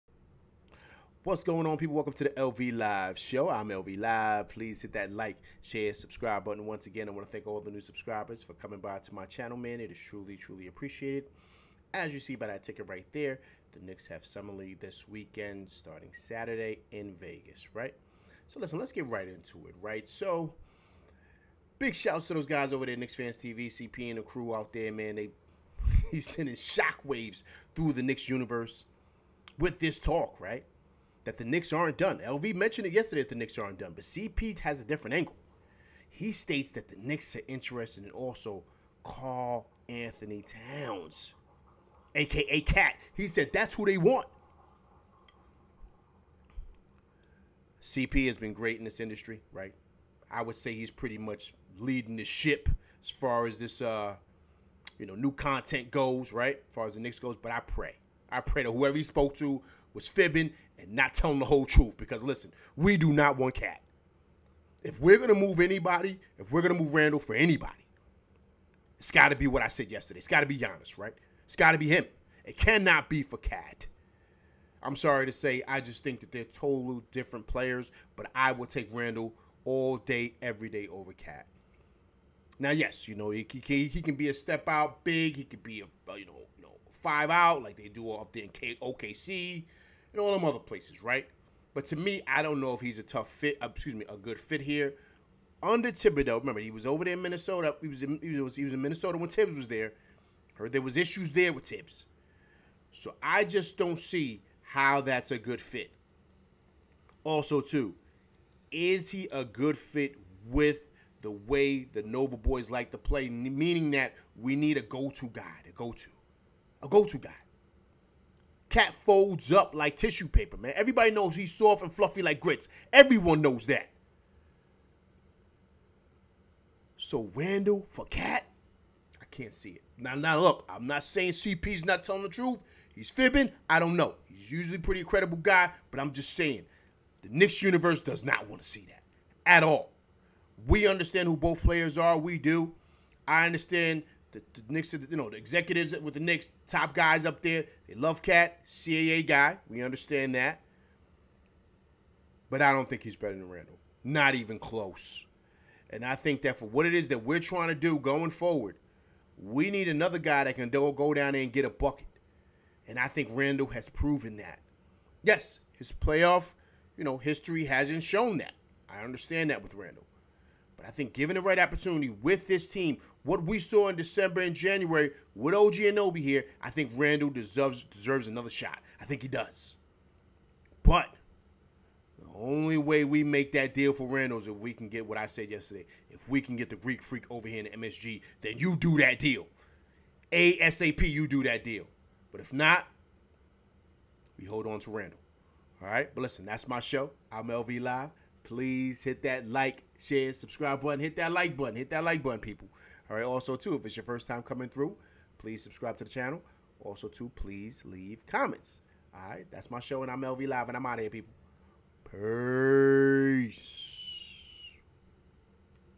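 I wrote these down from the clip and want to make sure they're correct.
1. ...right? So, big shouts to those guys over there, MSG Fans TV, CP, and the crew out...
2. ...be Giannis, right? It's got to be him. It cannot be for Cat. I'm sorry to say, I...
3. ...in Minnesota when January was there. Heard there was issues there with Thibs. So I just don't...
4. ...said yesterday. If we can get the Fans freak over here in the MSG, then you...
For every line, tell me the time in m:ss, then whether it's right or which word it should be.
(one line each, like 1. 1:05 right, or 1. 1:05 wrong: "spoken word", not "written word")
1. 0:19 wrong: "Knicks", not "MSG"
2. 1:10 right
3. 1:38 wrong: "Thibs", not "January"
4. 3:05 wrong: "Greek", not "Fans".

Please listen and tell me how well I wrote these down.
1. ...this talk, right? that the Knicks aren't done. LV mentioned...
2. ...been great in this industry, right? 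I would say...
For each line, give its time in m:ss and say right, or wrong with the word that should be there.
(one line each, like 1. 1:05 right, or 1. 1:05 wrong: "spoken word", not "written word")
1. 0:29 right
2. 0:48 right.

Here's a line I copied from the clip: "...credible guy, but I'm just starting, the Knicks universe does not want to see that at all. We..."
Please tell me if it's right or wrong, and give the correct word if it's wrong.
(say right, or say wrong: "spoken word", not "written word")
wrong: "saying", not "starting".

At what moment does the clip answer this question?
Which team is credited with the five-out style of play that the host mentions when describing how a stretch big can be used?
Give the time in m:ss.
1:28.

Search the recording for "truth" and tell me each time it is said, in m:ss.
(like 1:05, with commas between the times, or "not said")
1:01, 2:12.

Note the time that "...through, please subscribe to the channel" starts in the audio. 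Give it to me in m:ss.
3:24.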